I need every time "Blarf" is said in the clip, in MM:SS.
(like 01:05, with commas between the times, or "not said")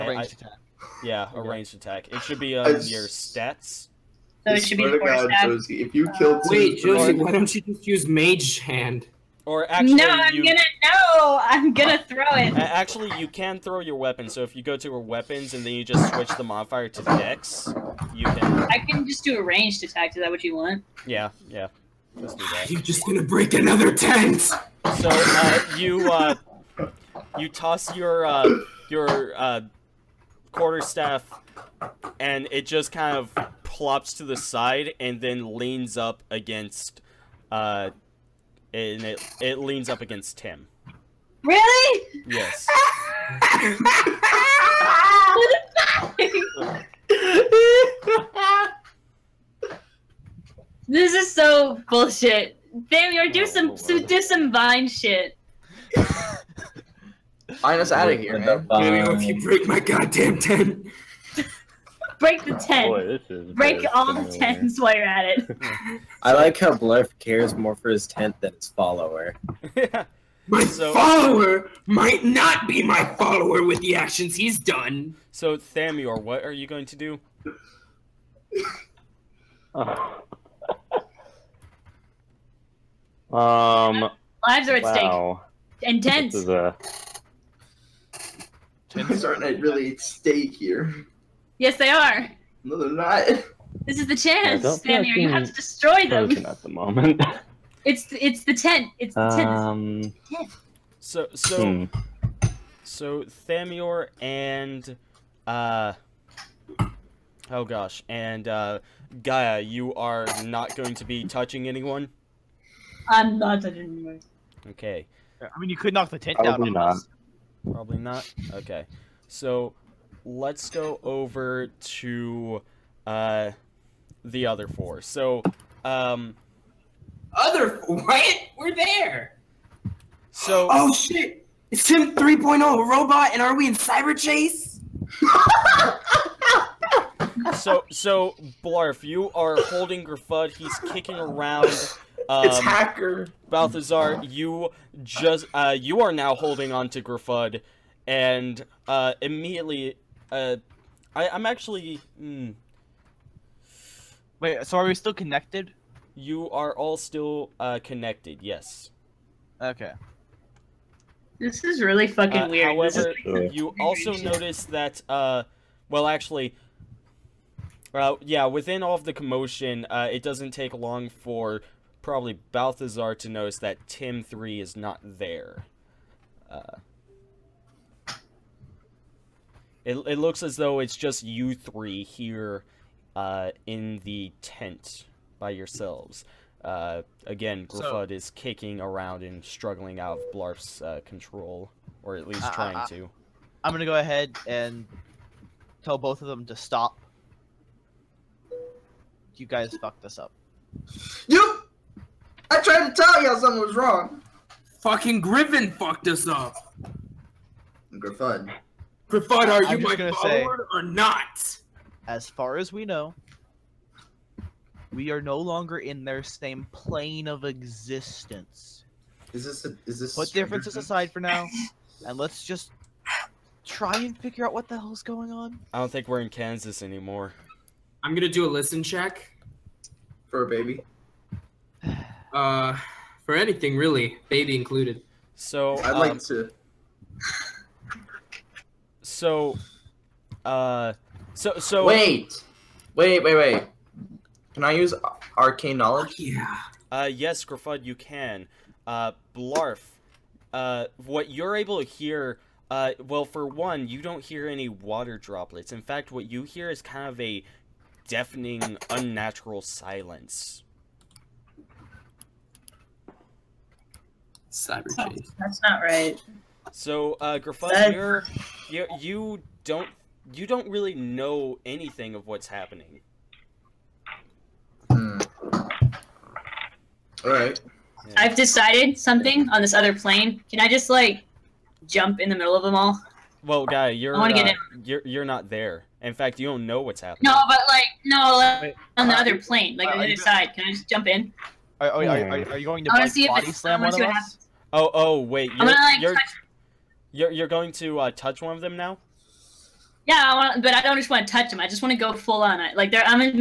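01:06, 02:18, 03:10, 04:09.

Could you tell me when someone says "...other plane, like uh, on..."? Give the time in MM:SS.
04:49.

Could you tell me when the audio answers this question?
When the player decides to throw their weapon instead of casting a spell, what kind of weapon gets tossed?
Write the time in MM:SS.
00:30.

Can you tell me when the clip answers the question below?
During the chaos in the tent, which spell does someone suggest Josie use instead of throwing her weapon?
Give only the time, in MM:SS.
00:08.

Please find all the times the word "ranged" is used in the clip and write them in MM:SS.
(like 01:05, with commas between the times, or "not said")
00:01, 00:19.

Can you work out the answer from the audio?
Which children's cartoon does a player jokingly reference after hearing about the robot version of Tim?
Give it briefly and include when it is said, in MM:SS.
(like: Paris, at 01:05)
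Cyberchase, at 02:13.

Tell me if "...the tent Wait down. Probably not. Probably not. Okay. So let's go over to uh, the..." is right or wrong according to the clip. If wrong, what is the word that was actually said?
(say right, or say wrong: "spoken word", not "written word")
wrong: "Probably", not "Wait".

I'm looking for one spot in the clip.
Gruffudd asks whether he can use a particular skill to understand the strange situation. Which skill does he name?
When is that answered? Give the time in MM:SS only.
04:05.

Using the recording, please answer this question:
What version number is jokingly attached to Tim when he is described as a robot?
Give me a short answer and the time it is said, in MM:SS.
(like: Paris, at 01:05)
3.0, at 02:12.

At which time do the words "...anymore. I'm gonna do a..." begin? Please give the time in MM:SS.
03:46.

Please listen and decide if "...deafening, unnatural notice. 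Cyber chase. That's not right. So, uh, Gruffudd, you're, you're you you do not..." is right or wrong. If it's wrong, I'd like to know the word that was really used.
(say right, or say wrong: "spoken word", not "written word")
wrong: "silence", not "notice".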